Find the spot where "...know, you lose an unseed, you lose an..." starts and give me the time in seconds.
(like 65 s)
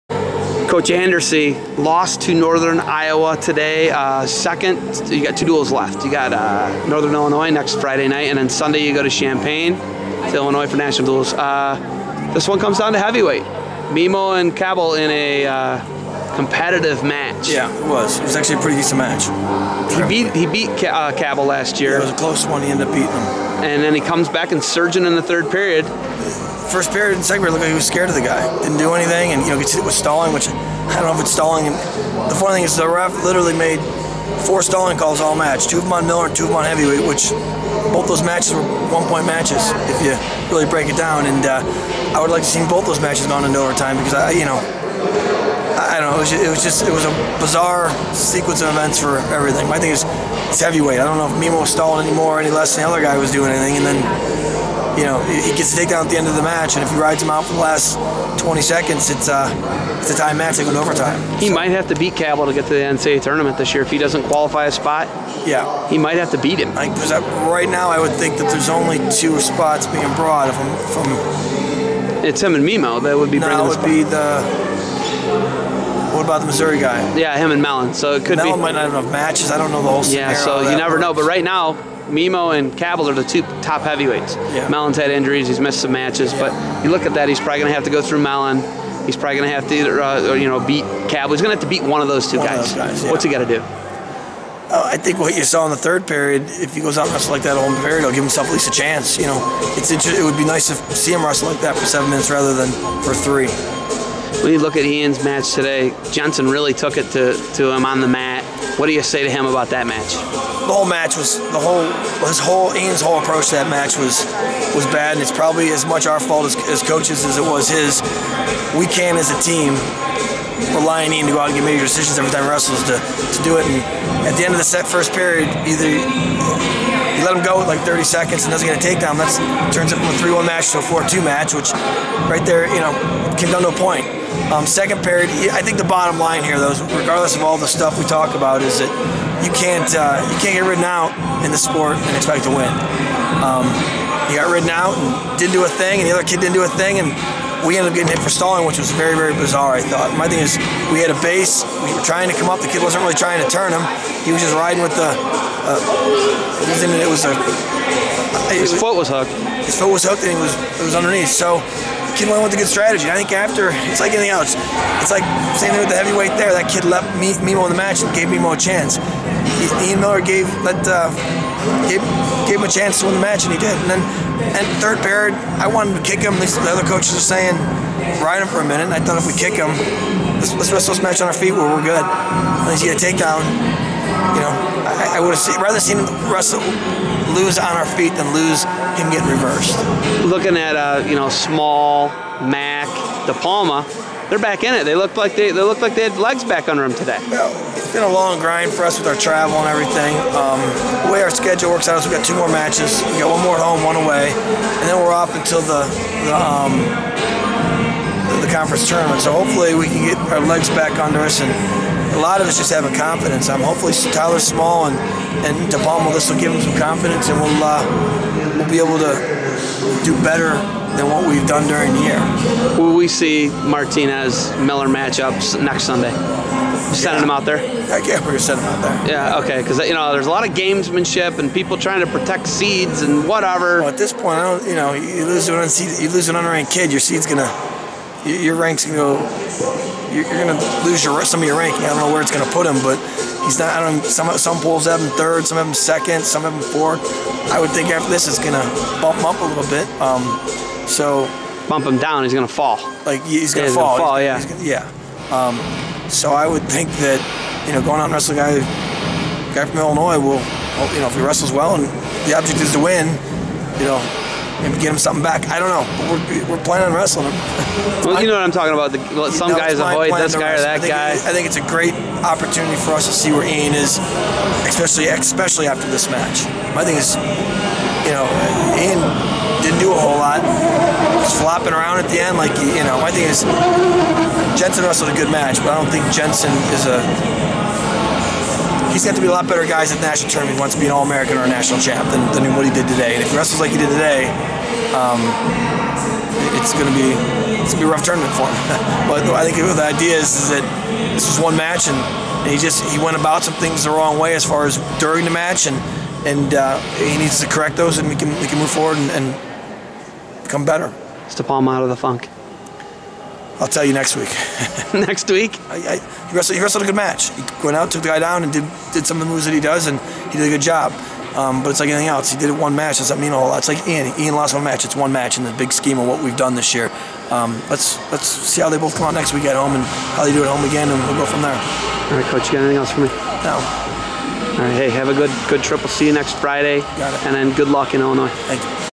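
234 s.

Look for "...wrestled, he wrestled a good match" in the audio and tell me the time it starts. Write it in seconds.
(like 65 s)
316 s.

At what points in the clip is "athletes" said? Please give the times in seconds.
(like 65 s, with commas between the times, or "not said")
not said.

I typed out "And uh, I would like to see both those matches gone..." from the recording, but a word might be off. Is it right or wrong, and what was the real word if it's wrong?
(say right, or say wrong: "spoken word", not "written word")
right.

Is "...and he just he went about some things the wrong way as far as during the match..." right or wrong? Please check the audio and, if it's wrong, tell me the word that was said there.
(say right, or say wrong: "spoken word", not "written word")
right.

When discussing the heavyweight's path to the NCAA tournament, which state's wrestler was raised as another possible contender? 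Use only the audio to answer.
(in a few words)
Missouri.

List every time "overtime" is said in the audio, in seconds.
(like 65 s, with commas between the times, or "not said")
43 s, 60 s.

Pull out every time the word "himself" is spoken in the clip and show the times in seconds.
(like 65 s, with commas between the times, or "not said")
98 s.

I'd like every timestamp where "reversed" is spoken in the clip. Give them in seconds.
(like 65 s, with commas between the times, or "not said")
189 s.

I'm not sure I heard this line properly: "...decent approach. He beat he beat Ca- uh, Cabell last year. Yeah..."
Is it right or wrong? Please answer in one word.
wrong.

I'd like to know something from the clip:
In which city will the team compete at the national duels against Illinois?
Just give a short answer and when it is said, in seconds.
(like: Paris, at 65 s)
Champaign, at 9 s.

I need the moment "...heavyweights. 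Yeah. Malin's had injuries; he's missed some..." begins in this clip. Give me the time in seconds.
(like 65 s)
83 s.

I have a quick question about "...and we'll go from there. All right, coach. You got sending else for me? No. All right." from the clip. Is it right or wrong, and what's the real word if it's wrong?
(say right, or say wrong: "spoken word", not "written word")
wrong: "anything", not "sending".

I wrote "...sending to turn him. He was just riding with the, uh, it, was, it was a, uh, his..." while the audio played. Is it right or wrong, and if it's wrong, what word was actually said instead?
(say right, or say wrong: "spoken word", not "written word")
wrong: "trying", not "sending".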